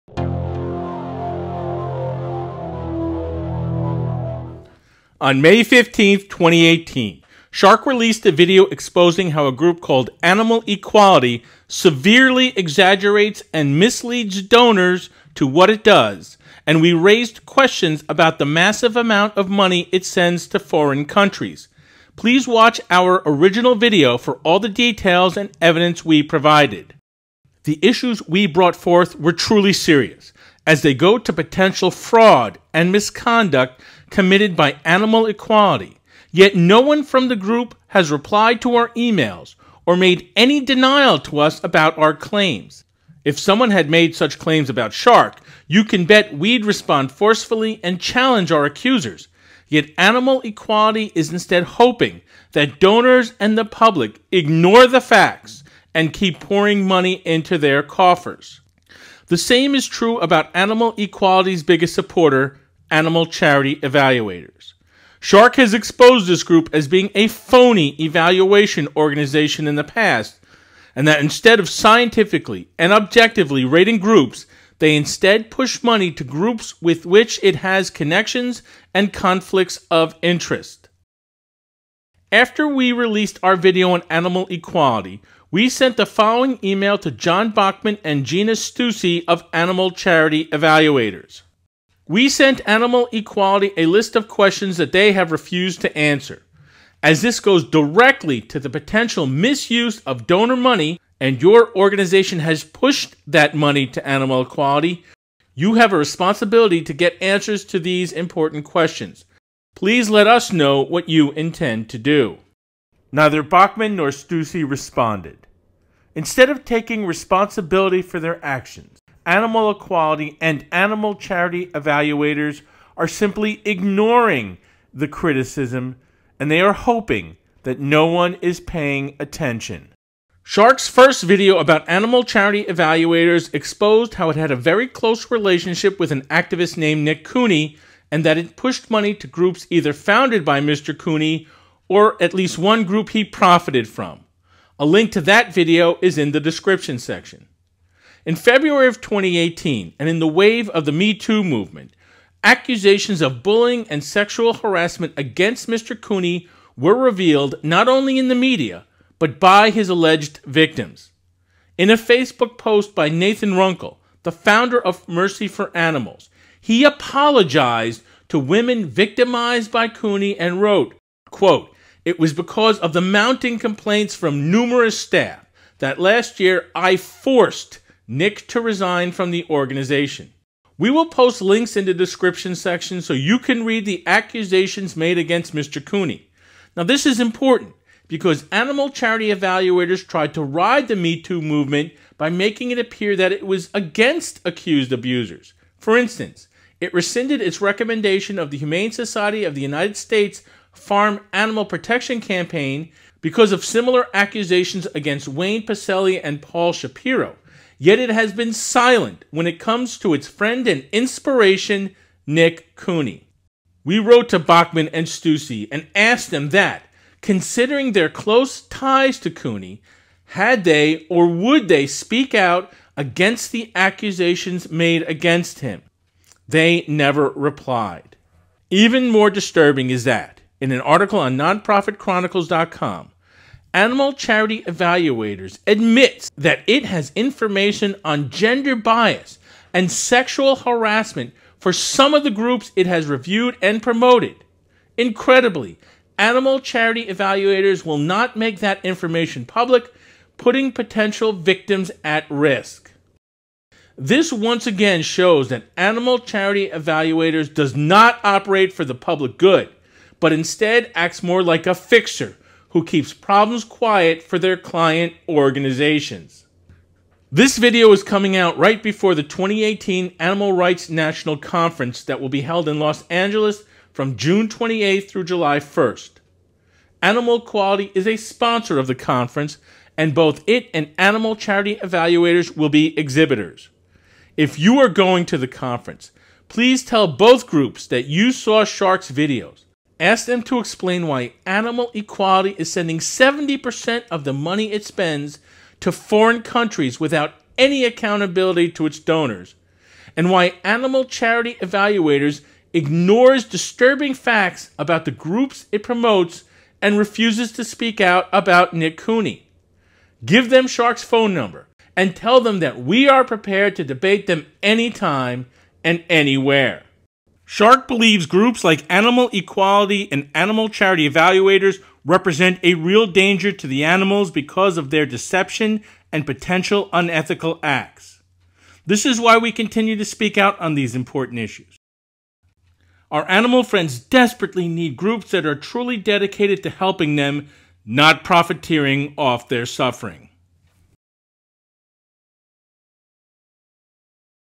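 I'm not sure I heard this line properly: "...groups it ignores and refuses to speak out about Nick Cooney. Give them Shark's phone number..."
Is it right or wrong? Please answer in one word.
wrong.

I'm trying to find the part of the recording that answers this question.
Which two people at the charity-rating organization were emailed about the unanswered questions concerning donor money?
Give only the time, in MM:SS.
01:27.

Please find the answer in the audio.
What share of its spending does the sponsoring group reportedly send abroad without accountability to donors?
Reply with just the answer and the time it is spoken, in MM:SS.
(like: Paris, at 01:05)
70%, at 04:52.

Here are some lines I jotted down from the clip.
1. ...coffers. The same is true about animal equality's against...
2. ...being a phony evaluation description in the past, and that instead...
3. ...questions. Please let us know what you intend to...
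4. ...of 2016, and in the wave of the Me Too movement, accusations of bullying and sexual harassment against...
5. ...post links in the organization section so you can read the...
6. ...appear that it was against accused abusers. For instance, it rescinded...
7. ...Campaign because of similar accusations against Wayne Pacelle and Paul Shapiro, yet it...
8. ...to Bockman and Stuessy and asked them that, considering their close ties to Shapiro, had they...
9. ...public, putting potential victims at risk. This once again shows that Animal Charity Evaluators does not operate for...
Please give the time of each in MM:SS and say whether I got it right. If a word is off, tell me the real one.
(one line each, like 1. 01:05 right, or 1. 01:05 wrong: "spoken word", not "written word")
1. 00:57 wrong: "biggest", not "against"
2. 01:06 wrong: "organization", not "description"
3. 01:48 right
4. 02:28 wrong: "2018", not "2016"
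5. 03:01 wrong: "description", not "organization"
6. 03:12 right
7. 03:22 right
8. 03:34 wrong: "Cooney", not "Shapiro"
9. 04:09 right.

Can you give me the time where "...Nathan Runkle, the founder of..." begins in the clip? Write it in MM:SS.
02:43.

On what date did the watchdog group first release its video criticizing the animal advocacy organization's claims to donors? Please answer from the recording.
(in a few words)
May 15, 2018.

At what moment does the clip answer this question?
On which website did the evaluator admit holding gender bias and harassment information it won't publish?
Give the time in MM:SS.
03:51.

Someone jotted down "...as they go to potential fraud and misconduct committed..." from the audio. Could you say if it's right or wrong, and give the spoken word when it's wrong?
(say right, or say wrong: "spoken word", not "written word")
right.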